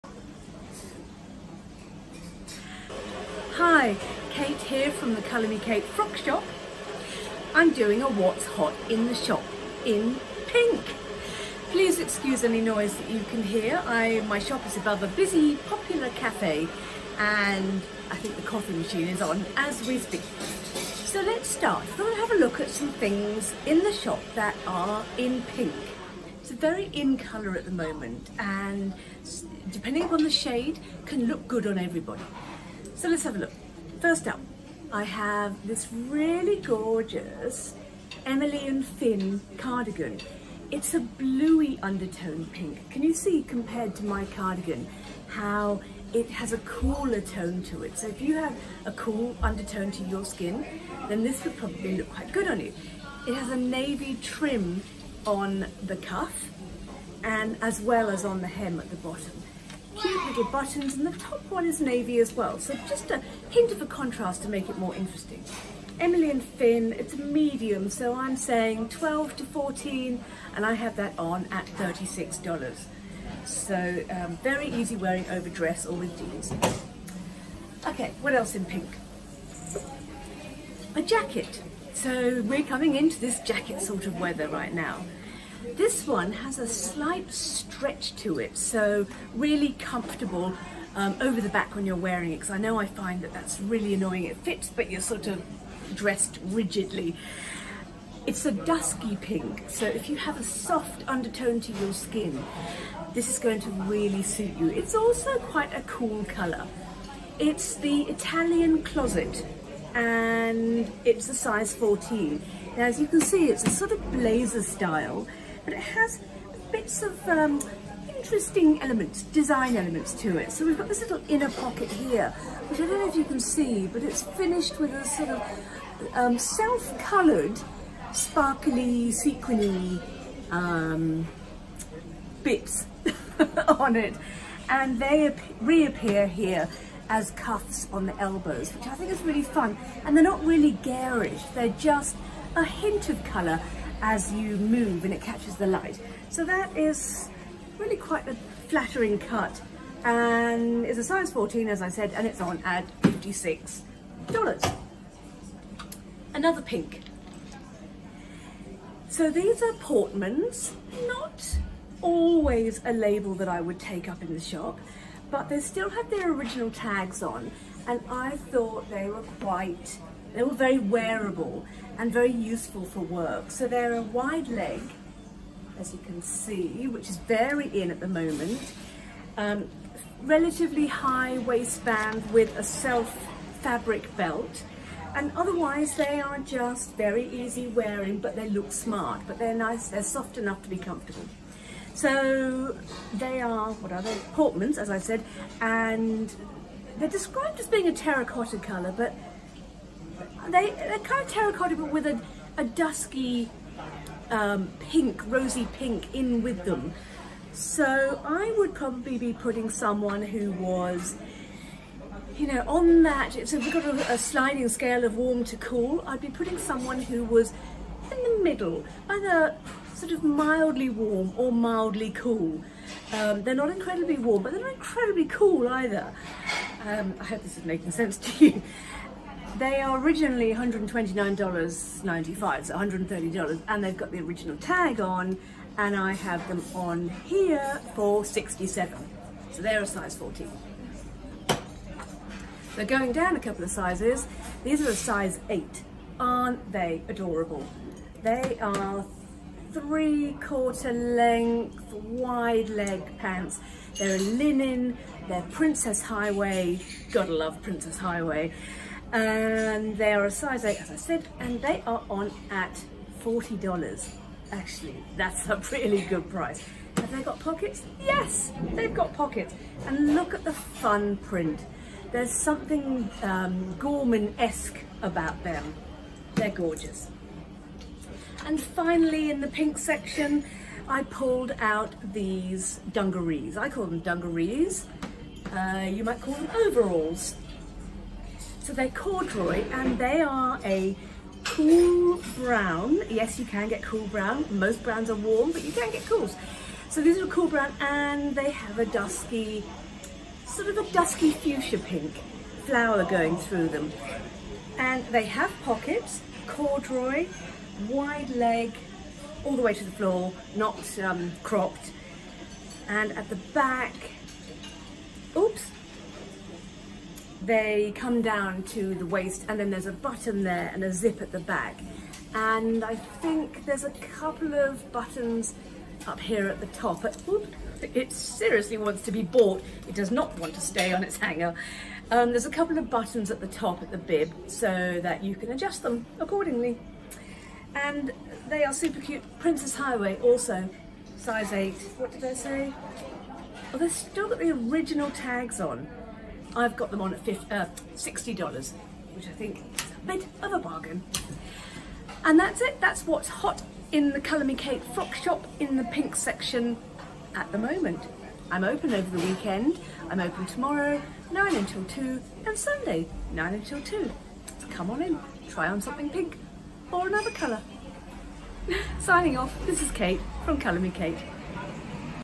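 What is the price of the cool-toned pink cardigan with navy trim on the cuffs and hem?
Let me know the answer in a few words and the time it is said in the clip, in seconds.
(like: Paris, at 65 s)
$36, at 71 s.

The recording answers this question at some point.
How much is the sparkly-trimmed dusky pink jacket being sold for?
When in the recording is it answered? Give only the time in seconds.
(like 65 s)
153 s.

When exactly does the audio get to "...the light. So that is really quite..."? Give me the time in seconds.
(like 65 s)
145 s.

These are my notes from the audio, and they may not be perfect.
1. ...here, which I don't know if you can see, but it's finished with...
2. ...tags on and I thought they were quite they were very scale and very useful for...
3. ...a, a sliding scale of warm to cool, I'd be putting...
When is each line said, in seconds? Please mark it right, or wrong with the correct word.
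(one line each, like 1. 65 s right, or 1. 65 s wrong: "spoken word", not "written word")
1. 121 s right
2. 166 s wrong: "wearable", not "scale"
3. 213 s right.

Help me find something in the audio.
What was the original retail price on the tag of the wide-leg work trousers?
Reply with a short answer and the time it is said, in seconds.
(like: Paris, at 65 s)
$129.95, at 230 s.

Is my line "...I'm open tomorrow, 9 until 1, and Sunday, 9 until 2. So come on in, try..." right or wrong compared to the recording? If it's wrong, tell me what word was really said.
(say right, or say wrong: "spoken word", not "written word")
wrong: "2", not "1".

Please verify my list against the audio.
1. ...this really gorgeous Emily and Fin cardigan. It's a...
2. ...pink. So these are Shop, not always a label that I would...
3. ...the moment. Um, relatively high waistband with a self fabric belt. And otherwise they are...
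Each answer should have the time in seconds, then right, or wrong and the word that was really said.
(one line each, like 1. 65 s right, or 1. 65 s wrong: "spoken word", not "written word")
1. 35 s right
2. 156 s wrong: "Portmans", not "Shop"
3. 177 s right.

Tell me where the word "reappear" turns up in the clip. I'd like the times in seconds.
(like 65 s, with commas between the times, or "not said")
135 s.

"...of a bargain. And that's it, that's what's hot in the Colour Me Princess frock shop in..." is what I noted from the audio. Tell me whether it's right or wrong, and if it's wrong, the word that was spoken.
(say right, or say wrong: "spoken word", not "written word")
wrong: "Kate", not "Princess".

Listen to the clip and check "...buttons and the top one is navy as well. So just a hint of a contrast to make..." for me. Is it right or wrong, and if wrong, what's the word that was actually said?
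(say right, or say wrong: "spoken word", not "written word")
right.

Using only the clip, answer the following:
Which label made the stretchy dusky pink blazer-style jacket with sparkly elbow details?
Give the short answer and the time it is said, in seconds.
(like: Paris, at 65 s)
Italian Closet, at 108 s.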